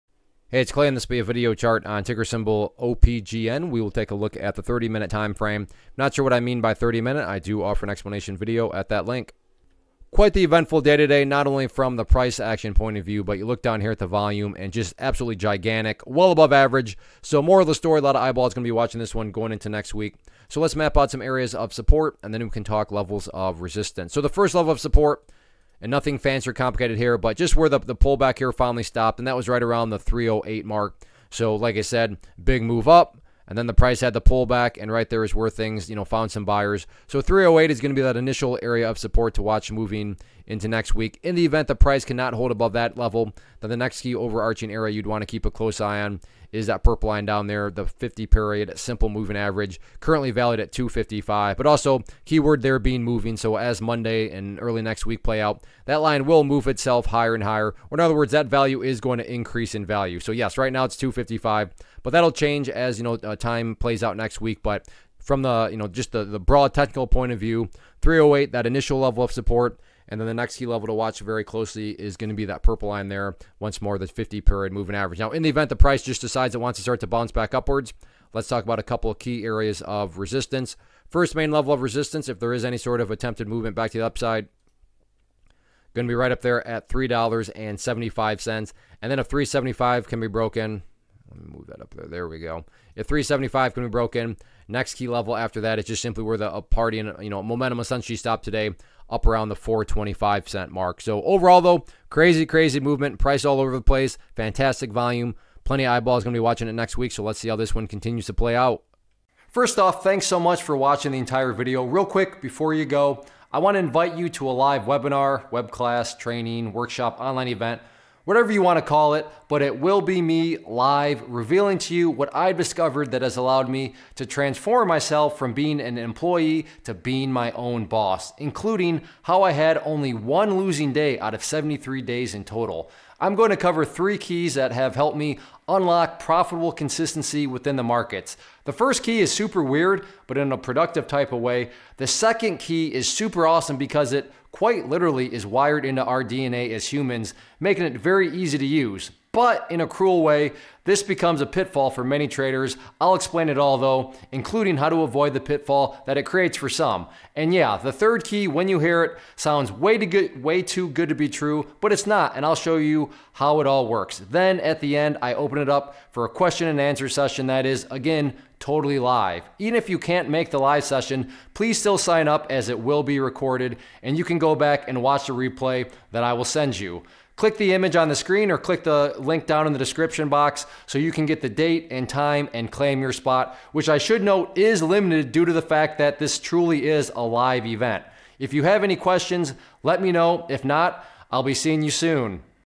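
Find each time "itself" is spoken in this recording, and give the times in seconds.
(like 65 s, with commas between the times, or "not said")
56 s.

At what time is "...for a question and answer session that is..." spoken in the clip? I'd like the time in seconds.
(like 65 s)
166 s.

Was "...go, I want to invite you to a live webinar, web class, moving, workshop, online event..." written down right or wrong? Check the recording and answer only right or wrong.
wrong.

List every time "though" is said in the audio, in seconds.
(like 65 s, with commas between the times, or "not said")
101 s, 153 s.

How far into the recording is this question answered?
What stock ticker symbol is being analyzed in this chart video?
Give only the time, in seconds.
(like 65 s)
2 s.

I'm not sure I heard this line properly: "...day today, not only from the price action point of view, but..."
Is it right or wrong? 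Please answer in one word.
right.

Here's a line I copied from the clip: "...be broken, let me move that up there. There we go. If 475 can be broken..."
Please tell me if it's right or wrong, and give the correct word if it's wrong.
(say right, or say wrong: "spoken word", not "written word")
wrong: "375", not "475".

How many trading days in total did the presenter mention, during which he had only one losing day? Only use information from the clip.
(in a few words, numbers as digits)
73.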